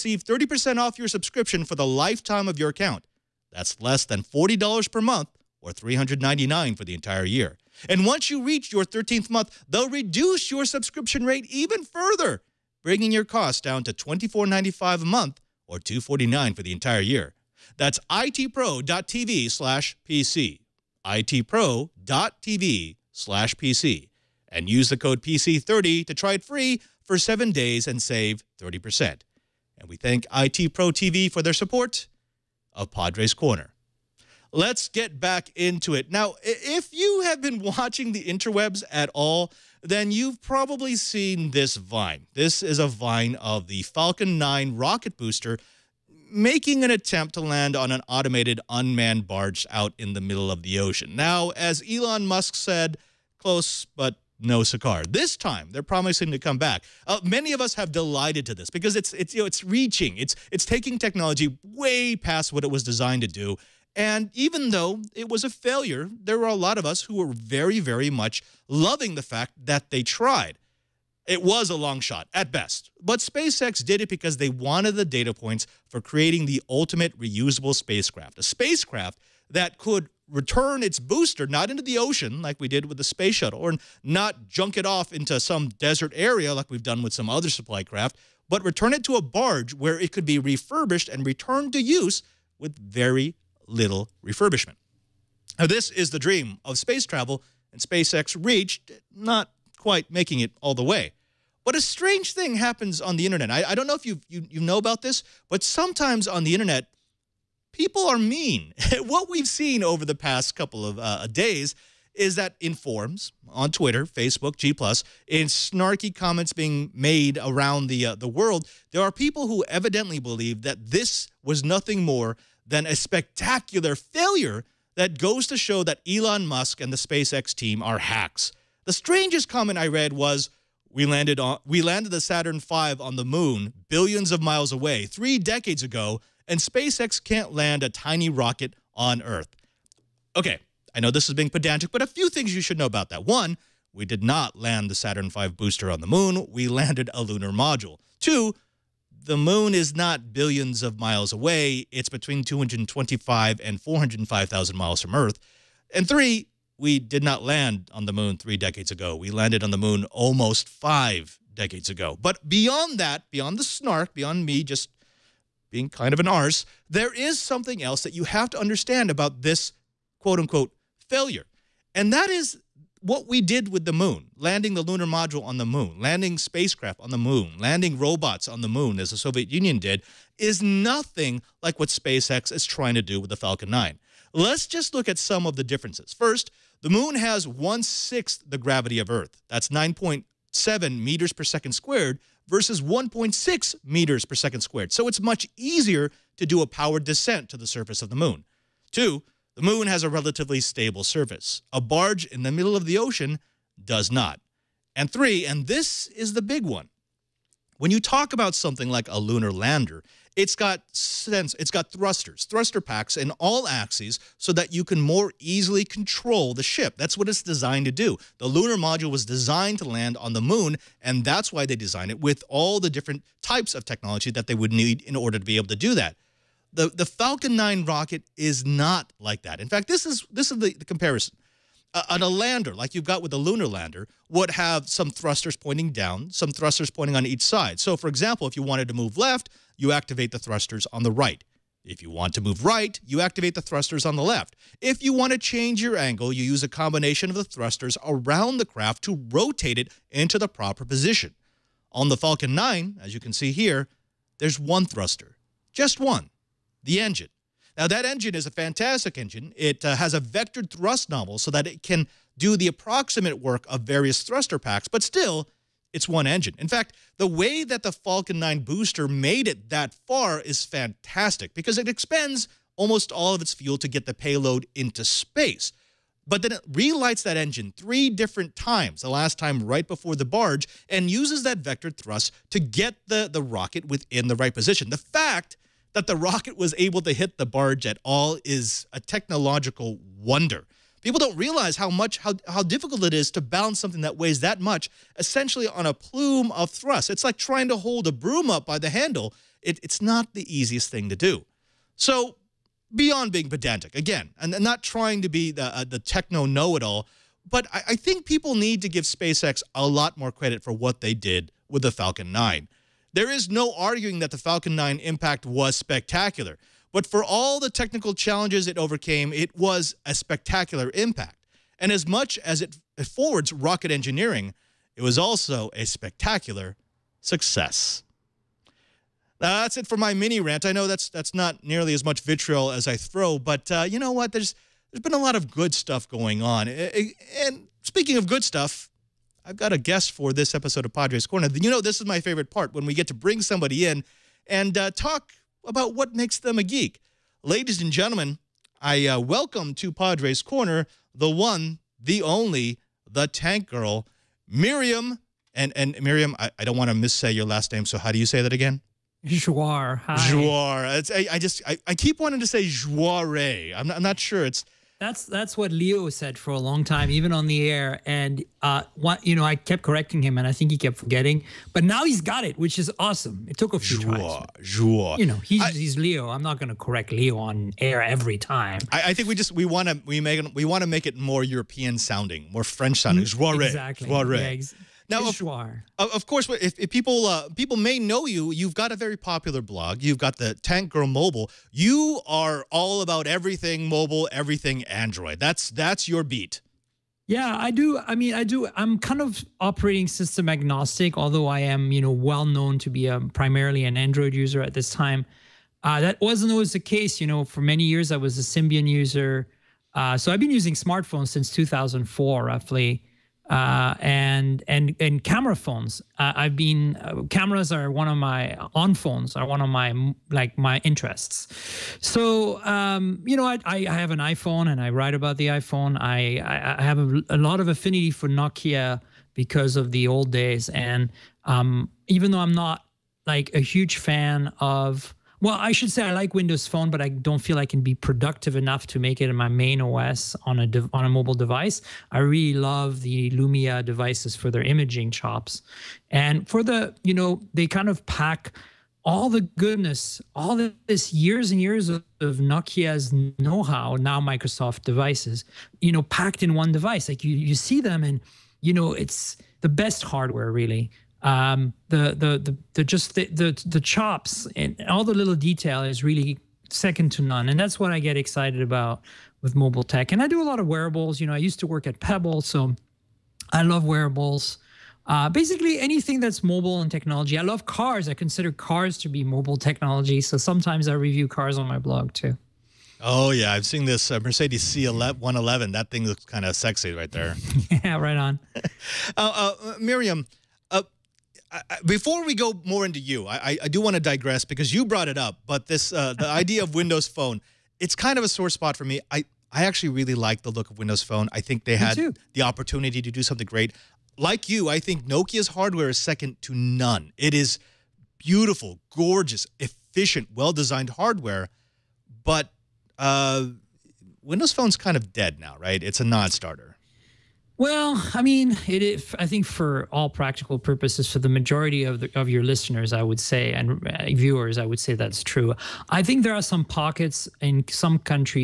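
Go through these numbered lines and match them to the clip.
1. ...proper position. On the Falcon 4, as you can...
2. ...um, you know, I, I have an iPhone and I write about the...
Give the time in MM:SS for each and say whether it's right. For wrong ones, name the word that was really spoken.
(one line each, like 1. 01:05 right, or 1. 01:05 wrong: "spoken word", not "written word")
1. 04:10 wrong: "9", not "4"
2. 07:02 right.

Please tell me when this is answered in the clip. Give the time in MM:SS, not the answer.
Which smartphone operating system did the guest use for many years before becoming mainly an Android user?
06:48.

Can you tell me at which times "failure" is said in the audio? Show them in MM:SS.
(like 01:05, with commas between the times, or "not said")
01:05, 02:03, 02:51.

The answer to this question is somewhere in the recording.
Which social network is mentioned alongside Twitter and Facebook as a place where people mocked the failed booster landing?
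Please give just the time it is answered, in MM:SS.
01:54.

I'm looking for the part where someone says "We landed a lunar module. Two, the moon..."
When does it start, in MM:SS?
02:26.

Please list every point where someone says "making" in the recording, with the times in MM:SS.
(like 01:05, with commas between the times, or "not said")
00:46, 01:40.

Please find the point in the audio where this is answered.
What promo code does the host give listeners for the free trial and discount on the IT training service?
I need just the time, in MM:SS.
00:25.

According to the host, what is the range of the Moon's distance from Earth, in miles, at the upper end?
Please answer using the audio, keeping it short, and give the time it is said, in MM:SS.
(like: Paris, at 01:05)
405,000 miles, at 02:33.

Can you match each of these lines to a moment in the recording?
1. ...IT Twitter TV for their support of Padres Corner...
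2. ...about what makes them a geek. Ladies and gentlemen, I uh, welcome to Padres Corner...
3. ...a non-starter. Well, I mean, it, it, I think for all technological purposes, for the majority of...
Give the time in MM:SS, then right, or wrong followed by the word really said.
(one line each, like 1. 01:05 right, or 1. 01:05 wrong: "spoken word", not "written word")
1. 00:30 wrong: "Pro", not "Twitter"
2. 05:45 right
3. 08:36 wrong: "practical", not "technological".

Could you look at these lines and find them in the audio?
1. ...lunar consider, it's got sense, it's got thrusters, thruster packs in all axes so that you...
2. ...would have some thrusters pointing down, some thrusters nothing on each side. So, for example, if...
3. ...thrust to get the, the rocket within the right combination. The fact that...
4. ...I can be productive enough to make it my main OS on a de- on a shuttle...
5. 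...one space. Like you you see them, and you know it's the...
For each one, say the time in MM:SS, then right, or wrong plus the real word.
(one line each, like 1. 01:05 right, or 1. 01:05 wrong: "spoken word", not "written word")
1. 03:29 wrong: "lander", not "consider"
2. 03:54 wrong: "pointing", not "nothing"
3. 04:41 wrong: "position", not "combination"
4. 07:17 wrong: "mobile", not "shuttle"
5. 07:36 wrong: "device", not "space".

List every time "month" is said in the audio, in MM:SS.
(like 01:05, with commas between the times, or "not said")
00:05, 00:09, 00:15.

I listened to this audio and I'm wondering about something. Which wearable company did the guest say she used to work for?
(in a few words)
Pebble.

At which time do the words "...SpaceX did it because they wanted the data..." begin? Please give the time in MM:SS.
01:13.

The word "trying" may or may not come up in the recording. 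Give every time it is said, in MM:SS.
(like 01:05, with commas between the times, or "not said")
03:02, 04:57, 05:04.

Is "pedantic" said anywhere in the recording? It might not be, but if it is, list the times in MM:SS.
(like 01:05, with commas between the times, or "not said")
02:21, 05:03.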